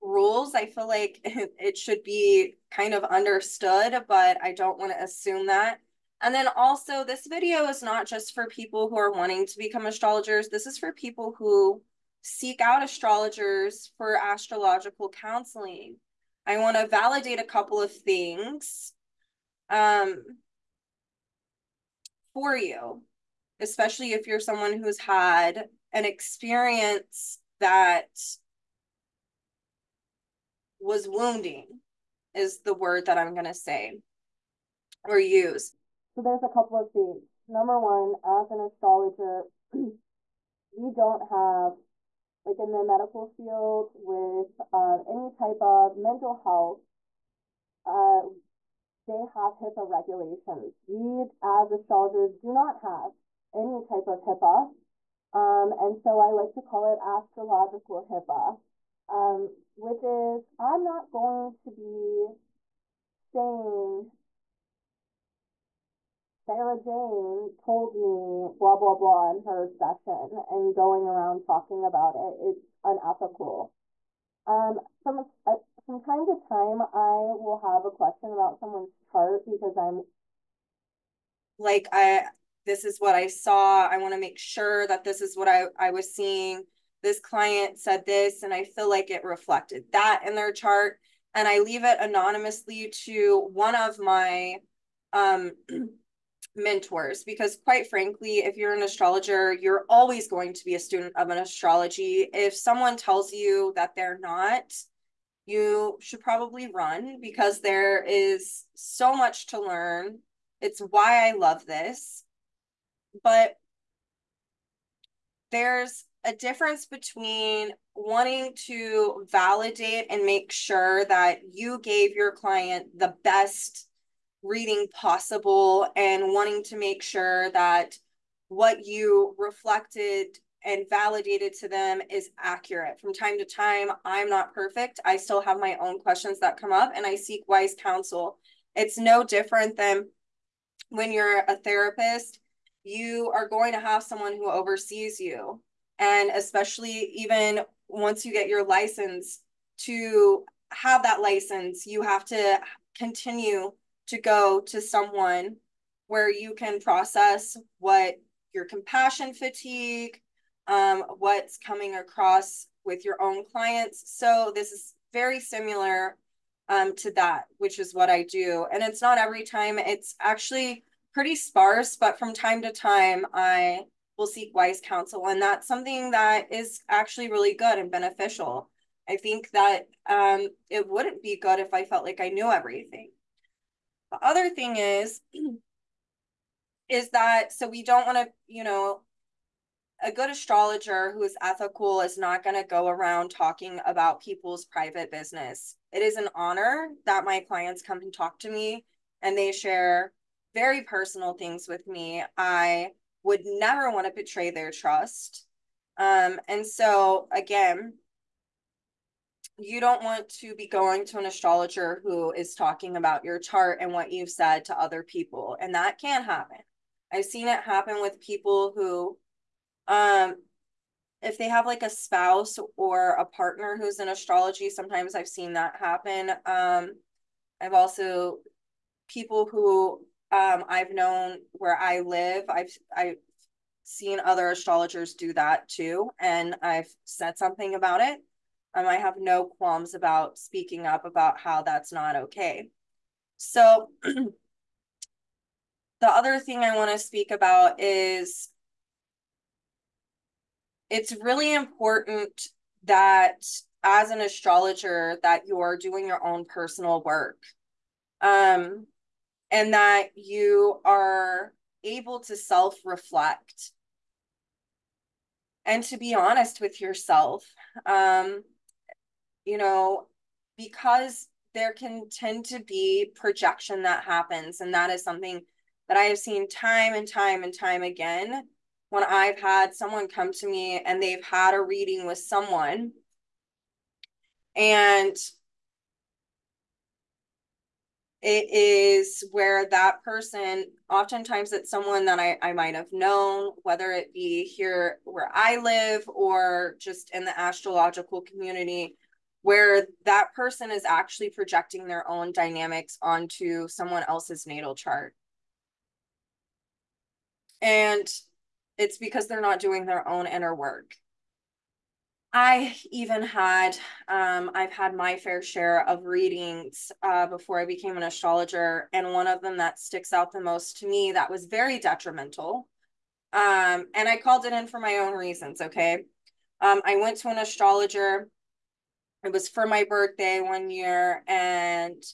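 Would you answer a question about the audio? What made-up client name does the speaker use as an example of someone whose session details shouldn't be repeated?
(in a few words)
Sarah Jane.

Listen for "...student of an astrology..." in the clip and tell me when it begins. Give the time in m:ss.
1:40.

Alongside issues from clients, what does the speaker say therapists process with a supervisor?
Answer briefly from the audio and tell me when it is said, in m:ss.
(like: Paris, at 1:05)
compassion fatigue, at 2:38.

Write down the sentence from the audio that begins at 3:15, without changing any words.
It is an honor that my clients come and talk to me and they share very personal things with me.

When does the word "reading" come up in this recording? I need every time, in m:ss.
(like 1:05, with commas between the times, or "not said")
2:04, 4:41, 5:16.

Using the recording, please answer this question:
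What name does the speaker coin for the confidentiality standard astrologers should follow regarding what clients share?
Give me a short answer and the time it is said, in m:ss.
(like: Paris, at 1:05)
astrological HIPAA, at 0:57.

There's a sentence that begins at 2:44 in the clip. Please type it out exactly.
So this is very similar um, to that, which is what I do.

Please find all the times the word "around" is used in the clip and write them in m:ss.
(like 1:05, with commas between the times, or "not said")
1:11, 3:12.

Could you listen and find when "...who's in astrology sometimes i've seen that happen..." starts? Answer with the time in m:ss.
3:43.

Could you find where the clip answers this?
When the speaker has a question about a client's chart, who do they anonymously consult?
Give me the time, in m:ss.
1:36.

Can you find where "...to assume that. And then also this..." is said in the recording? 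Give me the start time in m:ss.
0:04.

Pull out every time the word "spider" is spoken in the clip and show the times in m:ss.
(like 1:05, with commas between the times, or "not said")
not said.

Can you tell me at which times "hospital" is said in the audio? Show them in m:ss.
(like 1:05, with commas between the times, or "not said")
not said.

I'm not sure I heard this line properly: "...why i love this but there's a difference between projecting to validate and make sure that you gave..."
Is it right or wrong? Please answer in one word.
wrong.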